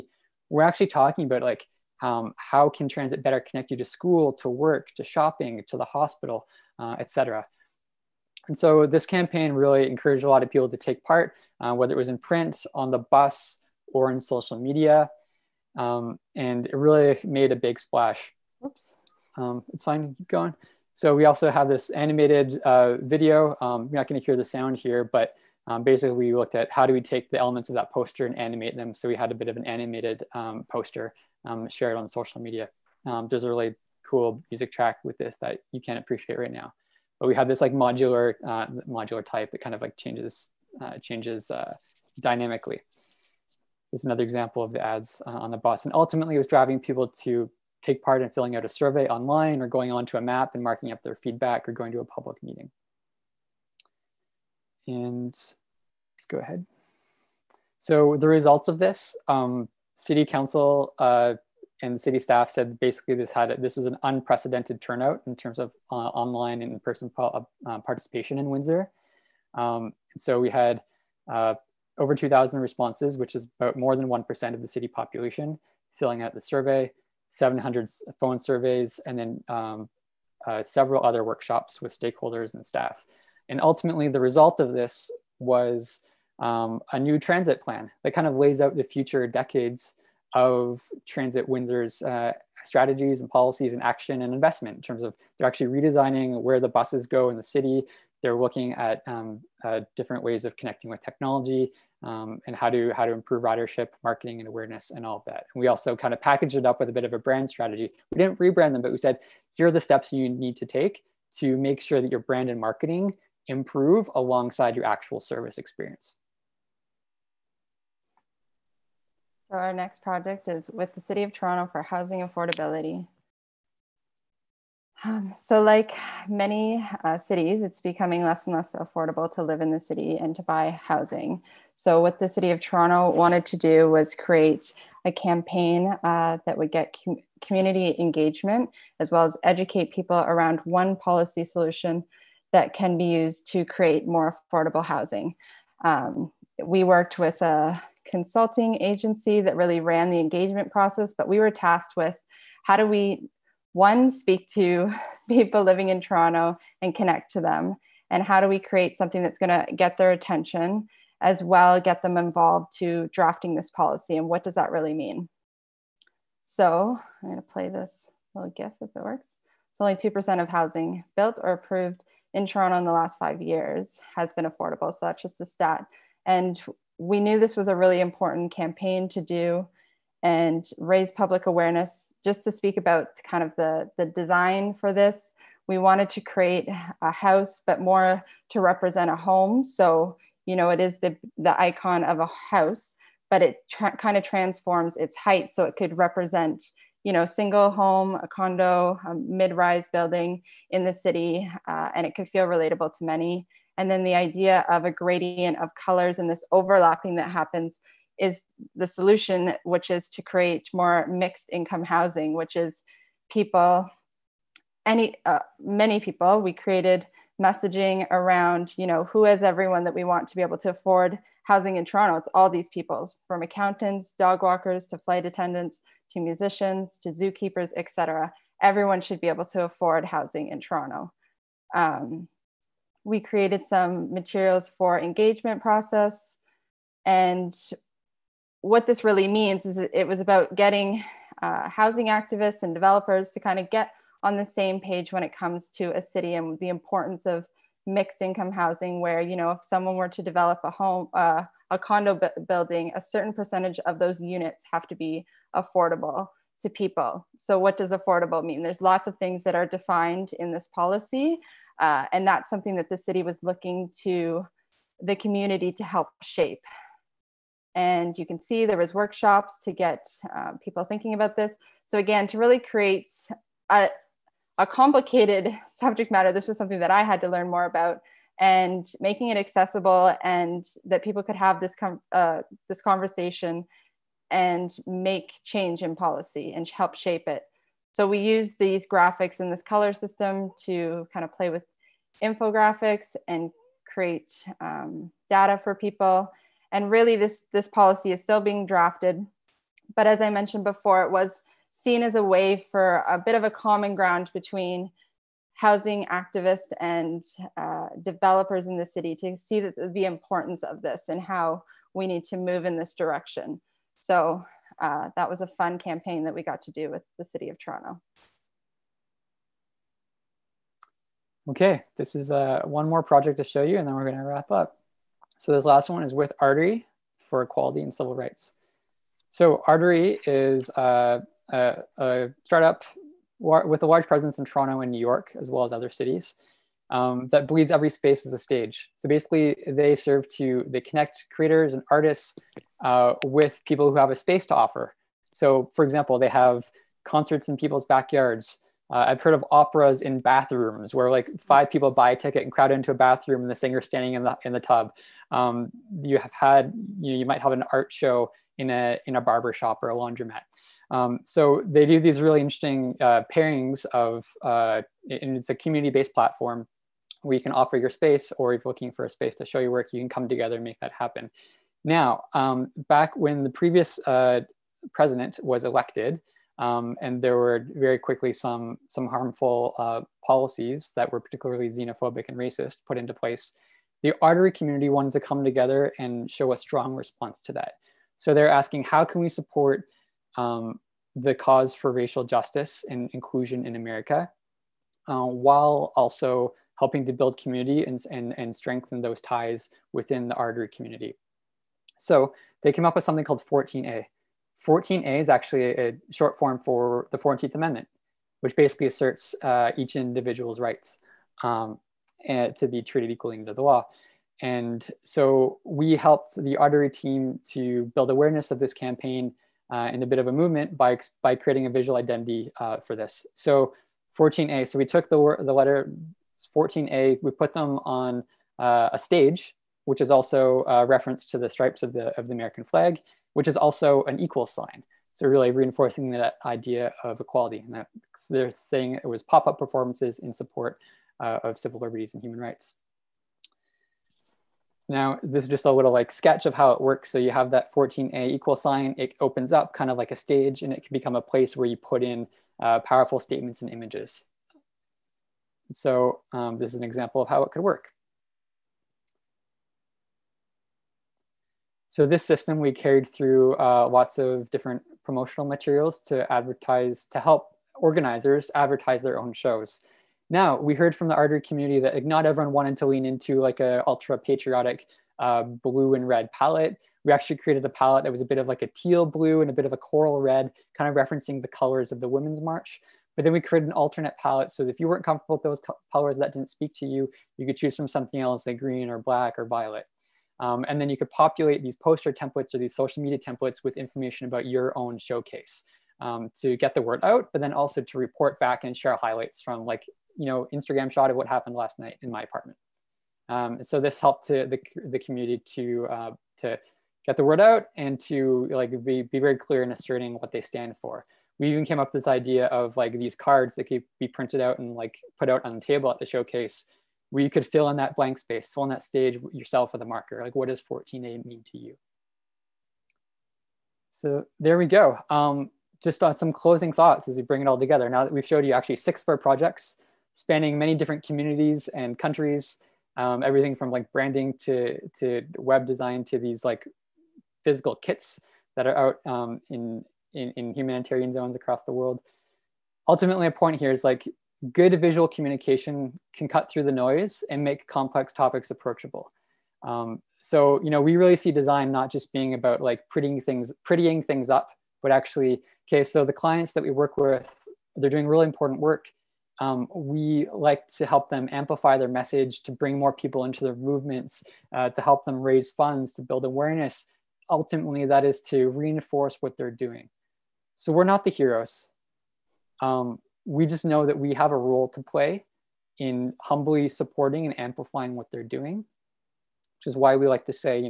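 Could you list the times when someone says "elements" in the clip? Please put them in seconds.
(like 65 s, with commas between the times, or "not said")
27 s.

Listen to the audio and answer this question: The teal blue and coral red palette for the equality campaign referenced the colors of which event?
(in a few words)
Women's March.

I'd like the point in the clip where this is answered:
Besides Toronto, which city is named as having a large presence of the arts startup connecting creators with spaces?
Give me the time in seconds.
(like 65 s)
334 s.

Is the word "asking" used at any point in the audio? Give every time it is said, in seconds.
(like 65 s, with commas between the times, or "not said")
388 s.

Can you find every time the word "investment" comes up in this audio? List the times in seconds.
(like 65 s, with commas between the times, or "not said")
94 s.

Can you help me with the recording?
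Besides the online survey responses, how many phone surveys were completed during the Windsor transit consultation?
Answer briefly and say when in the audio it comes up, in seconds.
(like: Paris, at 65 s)
700, at 77 s.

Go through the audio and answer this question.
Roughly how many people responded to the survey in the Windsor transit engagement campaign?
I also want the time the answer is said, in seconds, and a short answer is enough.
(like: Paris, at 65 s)
over 2,000, at 71 s.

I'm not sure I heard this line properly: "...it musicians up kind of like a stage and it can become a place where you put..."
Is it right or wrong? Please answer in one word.
wrong.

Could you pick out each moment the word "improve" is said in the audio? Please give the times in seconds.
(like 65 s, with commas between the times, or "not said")
103 s, 113 s.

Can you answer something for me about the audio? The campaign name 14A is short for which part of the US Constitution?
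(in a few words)
14th Amendment.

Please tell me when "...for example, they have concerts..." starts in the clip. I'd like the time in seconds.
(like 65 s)
345 s.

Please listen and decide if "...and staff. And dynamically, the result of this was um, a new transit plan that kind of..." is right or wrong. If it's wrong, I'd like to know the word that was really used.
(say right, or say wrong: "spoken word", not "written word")
wrong: "ultimately", not "dynamically".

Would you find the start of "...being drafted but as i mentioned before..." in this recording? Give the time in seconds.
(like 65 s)
298 s.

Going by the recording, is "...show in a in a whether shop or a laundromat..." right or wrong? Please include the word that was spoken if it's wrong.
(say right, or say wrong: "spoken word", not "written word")
wrong: "barber", not "whether".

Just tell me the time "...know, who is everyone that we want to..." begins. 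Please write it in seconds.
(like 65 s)
218 s.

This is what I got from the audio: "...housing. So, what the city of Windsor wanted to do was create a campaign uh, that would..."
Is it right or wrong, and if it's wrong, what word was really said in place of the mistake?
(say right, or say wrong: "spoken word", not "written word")
wrong: "Toronto", not "Windsor".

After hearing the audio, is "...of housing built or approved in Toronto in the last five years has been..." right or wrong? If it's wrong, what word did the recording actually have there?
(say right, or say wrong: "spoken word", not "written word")
right.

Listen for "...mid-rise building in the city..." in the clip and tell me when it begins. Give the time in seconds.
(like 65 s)
199 s.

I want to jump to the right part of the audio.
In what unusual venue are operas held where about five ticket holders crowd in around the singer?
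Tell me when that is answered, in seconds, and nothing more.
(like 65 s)
350 s.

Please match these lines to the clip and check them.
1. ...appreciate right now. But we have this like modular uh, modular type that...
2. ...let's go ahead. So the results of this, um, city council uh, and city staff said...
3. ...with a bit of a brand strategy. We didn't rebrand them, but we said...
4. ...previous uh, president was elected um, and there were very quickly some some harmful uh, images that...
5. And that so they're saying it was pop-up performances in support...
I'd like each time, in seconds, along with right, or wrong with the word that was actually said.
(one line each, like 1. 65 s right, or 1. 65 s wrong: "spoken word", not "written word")
1. 35 s right
2. 55 s right
3. 106 s right
4. 373 s wrong: "policies", not "images"
5. 437 s right.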